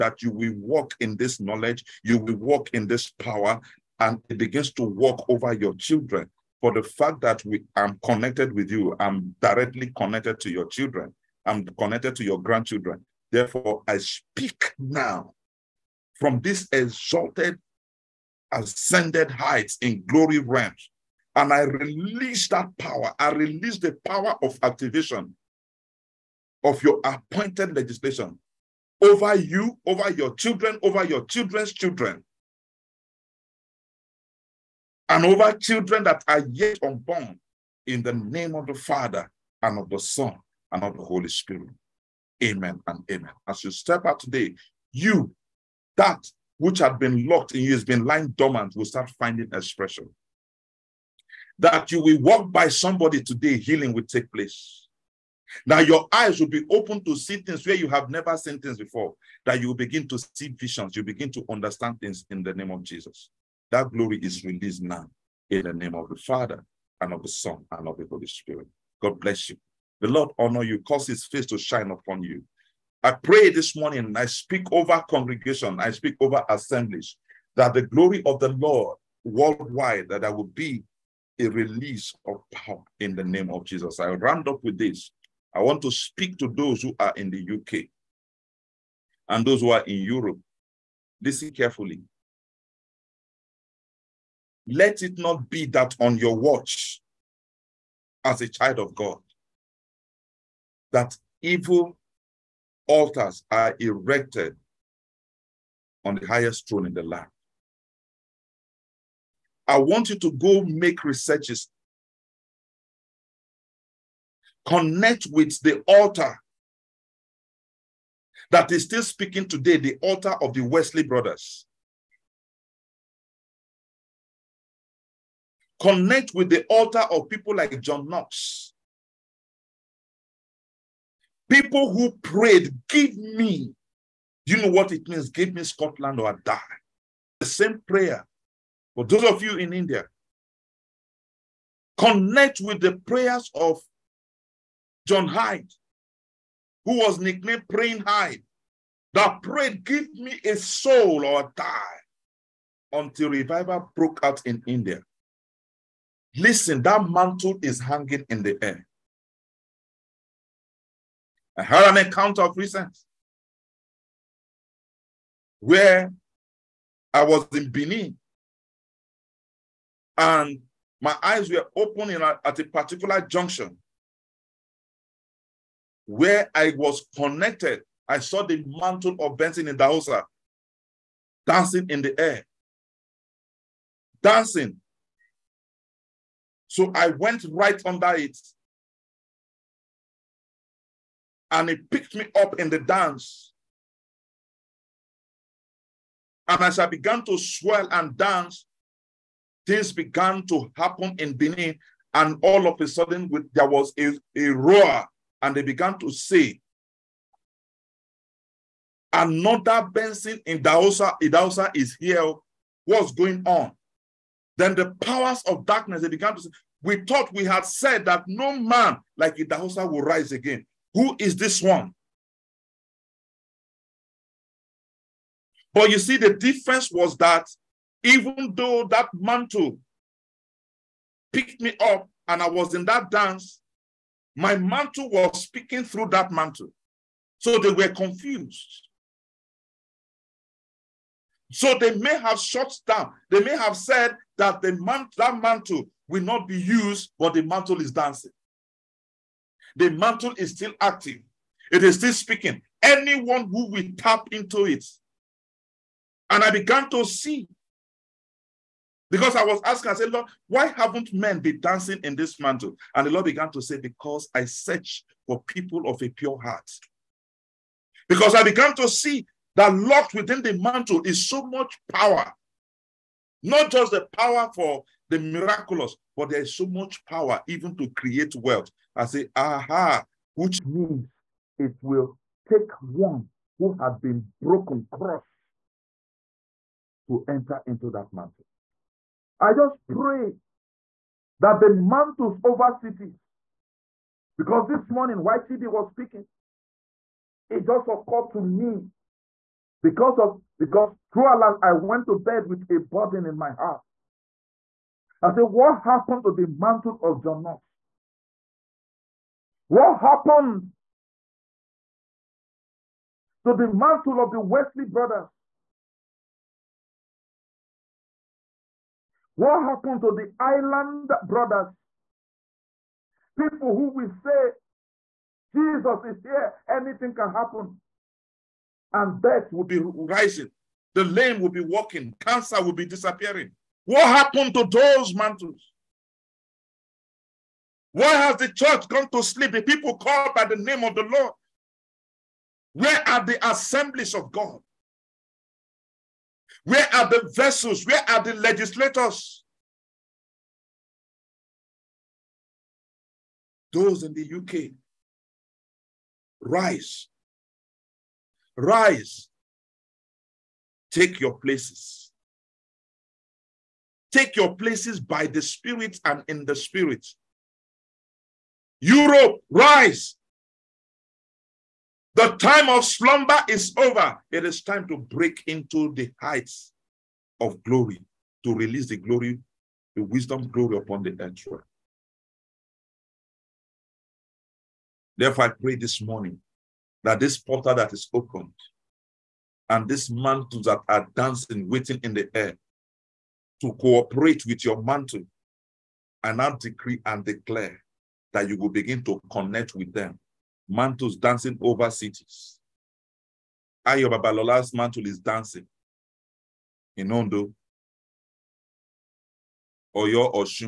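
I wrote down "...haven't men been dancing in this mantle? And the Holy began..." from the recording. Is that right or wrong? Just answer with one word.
wrong.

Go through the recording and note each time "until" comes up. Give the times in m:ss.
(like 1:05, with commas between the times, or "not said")
2:32.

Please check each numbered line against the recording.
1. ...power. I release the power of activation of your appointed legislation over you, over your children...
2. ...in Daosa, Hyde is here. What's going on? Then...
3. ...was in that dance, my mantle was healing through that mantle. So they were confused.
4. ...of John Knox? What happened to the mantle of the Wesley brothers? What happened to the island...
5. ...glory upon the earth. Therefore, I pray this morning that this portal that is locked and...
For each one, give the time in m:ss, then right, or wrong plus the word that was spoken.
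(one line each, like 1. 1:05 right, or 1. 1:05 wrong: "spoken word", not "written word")
1. 0:22 right
2. 3:30 wrong: "Idahosa", not "Hyde"
3. 3:52 wrong: "speaking", not "healing"
4. 5:07 right
5. 6:20 wrong: "opened", not "locked".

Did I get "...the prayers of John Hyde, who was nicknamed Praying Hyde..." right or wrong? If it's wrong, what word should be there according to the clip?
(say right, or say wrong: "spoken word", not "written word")
right.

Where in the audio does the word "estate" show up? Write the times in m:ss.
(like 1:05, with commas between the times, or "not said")
not said.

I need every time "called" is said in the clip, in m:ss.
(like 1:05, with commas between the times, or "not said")
5:39.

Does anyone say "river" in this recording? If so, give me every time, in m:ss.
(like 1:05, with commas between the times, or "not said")
not said.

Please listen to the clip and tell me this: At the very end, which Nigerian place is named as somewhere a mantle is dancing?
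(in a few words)
Ondo.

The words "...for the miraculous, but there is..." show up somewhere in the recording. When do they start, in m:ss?
4:34.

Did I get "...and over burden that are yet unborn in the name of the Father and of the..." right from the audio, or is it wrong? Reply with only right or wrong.
wrong.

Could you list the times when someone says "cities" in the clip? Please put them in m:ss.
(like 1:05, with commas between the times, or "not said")
4:52, 6:41.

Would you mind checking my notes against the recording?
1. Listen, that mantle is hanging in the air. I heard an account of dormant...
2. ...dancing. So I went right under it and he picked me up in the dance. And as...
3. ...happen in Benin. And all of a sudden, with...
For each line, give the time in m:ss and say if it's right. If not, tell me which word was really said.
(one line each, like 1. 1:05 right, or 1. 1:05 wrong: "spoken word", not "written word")
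1. 2:36 wrong: "recent", not "dormant"
2. 3:04 right
3. 3:20 right.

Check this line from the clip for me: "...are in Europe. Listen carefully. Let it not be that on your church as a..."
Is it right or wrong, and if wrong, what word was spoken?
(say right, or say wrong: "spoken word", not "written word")
wrong: "watch", not "church".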